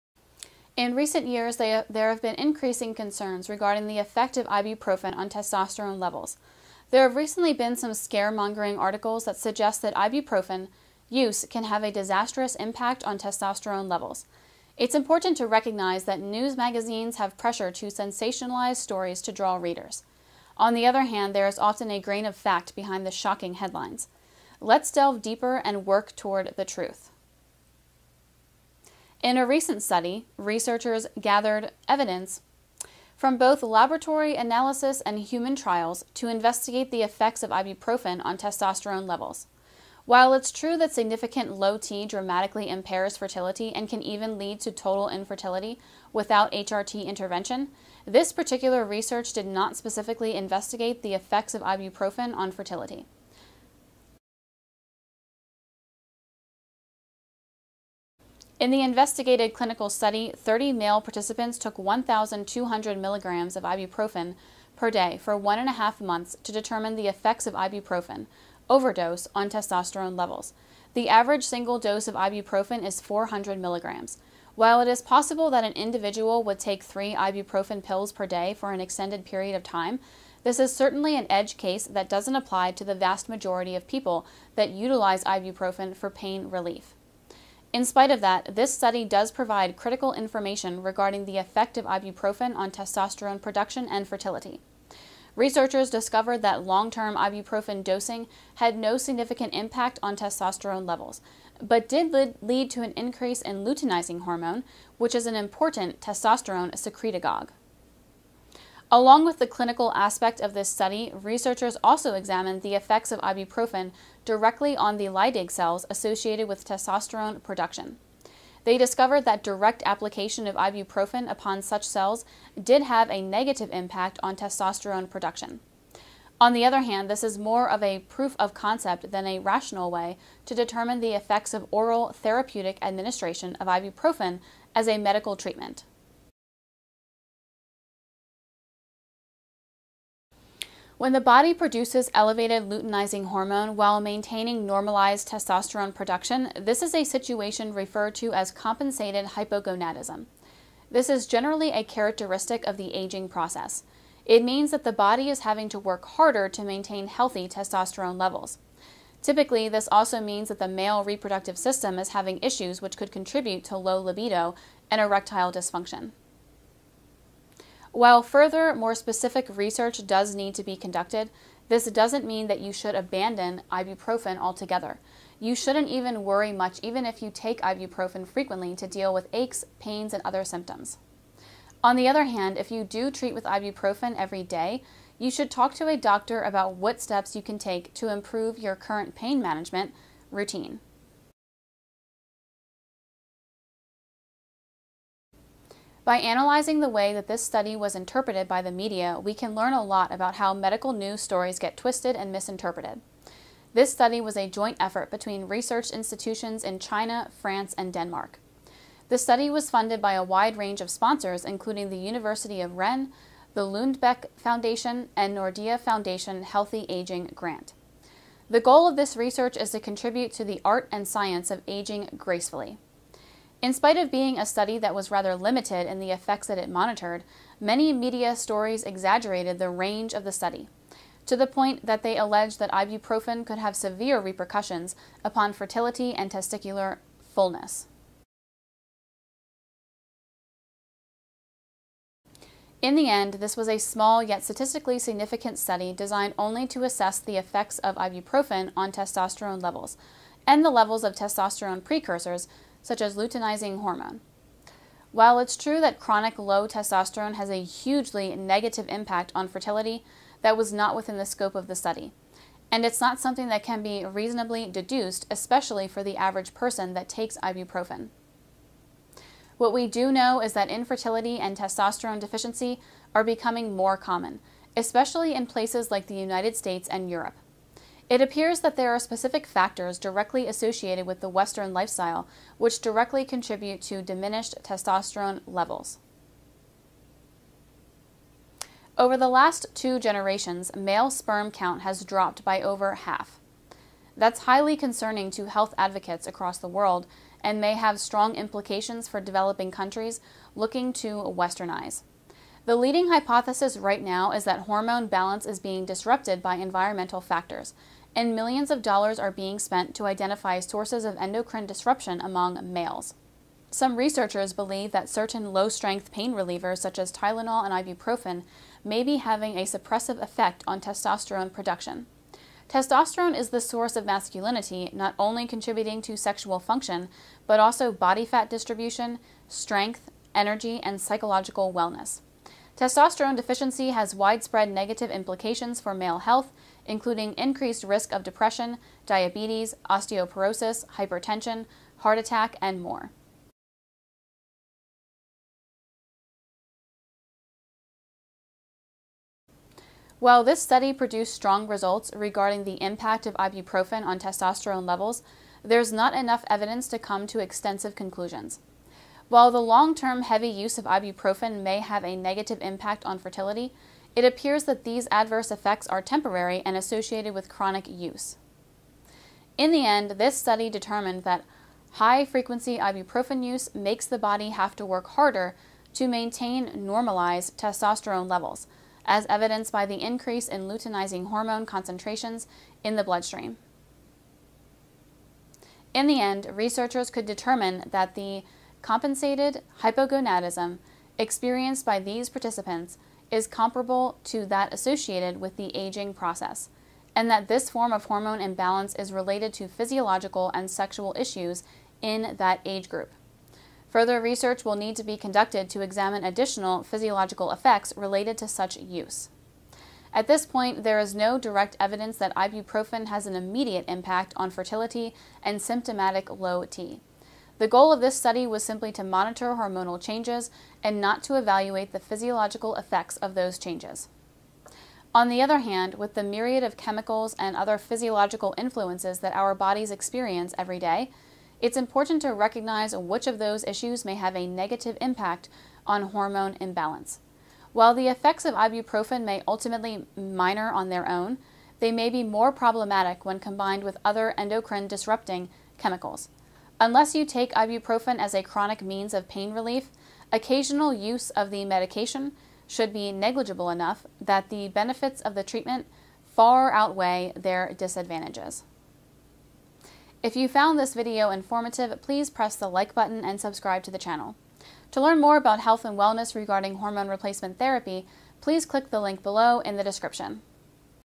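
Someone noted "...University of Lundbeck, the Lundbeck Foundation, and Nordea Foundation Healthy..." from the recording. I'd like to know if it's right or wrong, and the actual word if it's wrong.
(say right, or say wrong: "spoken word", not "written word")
wrong: "Rennes", not "Lundbeck".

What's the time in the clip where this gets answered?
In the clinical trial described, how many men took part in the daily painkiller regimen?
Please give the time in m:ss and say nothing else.
1:00.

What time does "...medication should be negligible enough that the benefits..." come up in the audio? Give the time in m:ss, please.
7:31.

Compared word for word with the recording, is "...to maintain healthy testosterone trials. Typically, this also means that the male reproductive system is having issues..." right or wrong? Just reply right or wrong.
wrong.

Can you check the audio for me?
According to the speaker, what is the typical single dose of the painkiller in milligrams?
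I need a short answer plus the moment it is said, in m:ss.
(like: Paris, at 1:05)
400 milligrams, at 1:13.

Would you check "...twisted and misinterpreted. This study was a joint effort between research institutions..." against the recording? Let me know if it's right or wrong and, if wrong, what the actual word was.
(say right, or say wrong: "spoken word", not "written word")
right.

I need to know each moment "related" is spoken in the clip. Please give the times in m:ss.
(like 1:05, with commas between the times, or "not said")
6:39, 6:47.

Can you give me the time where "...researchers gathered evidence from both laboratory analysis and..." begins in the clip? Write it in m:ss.
0:30.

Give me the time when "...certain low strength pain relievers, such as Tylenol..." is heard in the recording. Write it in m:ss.
5:15.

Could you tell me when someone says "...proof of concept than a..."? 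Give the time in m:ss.
2:07.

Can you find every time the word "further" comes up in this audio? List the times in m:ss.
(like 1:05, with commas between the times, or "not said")
2:48, 6:43.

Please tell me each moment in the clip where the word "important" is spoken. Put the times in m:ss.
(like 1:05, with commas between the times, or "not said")
0:14, 1:45, 7:11.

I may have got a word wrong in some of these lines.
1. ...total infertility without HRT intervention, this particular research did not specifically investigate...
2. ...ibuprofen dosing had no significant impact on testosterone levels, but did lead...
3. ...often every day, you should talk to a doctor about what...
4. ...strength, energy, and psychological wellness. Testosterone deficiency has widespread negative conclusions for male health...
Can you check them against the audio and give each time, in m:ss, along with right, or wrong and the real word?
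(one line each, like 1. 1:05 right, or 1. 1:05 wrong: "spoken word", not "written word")
1. 0:44 right
2. 1:37 right
3. 3:03 wrong: "ibuprofen", not "often"
4. 5:29 wrong: "implications", not "conclusions".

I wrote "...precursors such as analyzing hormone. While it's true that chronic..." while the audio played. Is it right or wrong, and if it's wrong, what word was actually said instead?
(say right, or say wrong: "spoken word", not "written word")
wrong: "luteinizing", not "analyzing".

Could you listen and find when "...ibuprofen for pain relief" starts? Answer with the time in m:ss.
1:25.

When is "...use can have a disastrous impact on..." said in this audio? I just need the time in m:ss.
0:11.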